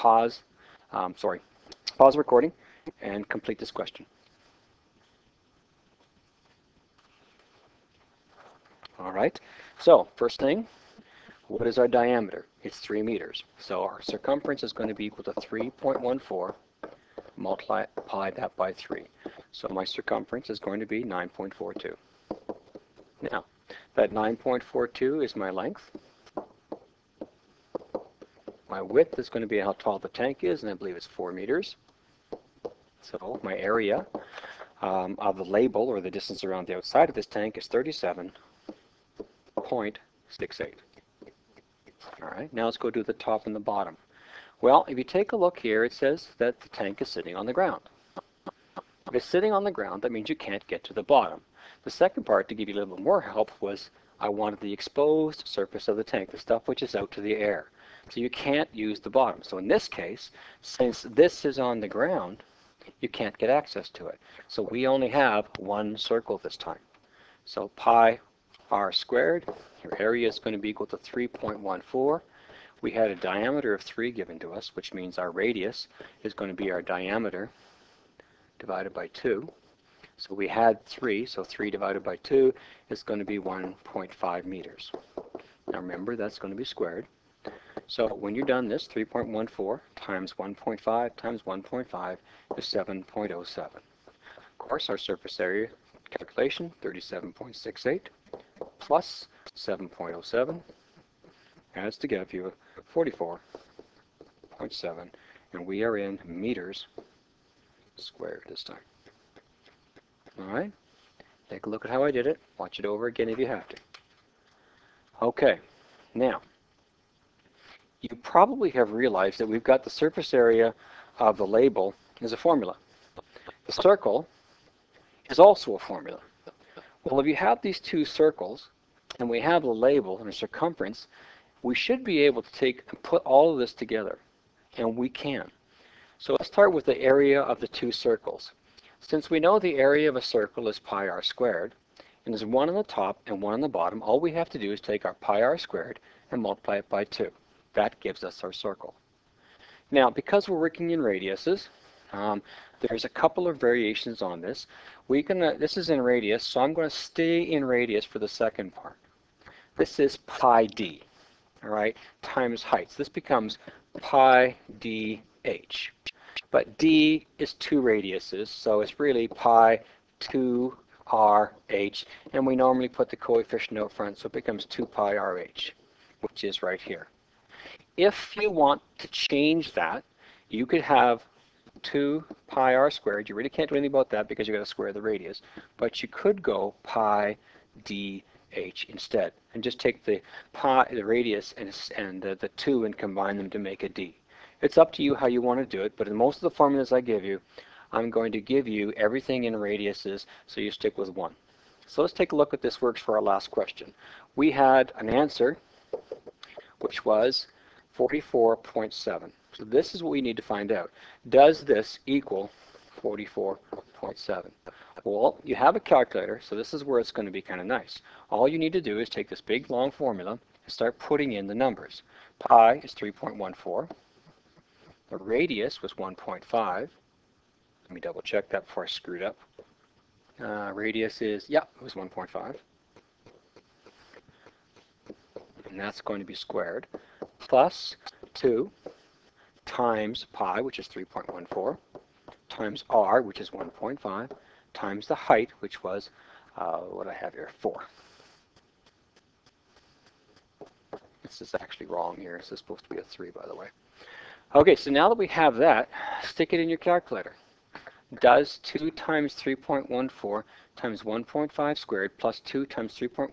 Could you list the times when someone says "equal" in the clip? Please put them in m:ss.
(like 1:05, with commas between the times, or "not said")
0:15, 1:10, 3:32.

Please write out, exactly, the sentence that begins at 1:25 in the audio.
Now remember, that's going to be squared.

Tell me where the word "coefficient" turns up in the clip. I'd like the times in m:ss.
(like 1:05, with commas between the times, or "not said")
2:53.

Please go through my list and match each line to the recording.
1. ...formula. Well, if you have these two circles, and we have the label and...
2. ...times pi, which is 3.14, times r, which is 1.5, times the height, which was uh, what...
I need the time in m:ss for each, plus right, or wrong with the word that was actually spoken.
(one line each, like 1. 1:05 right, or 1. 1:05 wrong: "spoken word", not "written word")
1. 2:05 right
2. 3:59 right.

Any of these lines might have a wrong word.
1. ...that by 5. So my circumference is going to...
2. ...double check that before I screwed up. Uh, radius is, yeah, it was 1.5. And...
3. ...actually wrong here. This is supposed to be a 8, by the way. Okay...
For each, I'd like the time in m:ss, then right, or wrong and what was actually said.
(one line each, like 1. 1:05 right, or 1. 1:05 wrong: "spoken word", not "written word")
1. 0:18 wrong: "3", not "5"
2. 3:47 right
3. 4:11 wrong: "3", not "8".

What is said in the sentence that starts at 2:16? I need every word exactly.
So let's start with the area of the two circles.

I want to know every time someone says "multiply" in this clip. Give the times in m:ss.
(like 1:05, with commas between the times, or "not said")
0:17, 2:26.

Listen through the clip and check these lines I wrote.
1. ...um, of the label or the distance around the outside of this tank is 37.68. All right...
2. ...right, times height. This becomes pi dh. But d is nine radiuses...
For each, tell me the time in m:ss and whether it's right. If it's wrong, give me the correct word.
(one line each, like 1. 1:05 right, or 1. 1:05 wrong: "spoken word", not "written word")
1. 0:34 right
2. 2:41 wrong: "two", not "nine".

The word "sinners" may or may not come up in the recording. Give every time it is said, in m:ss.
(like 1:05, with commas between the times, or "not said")
not said.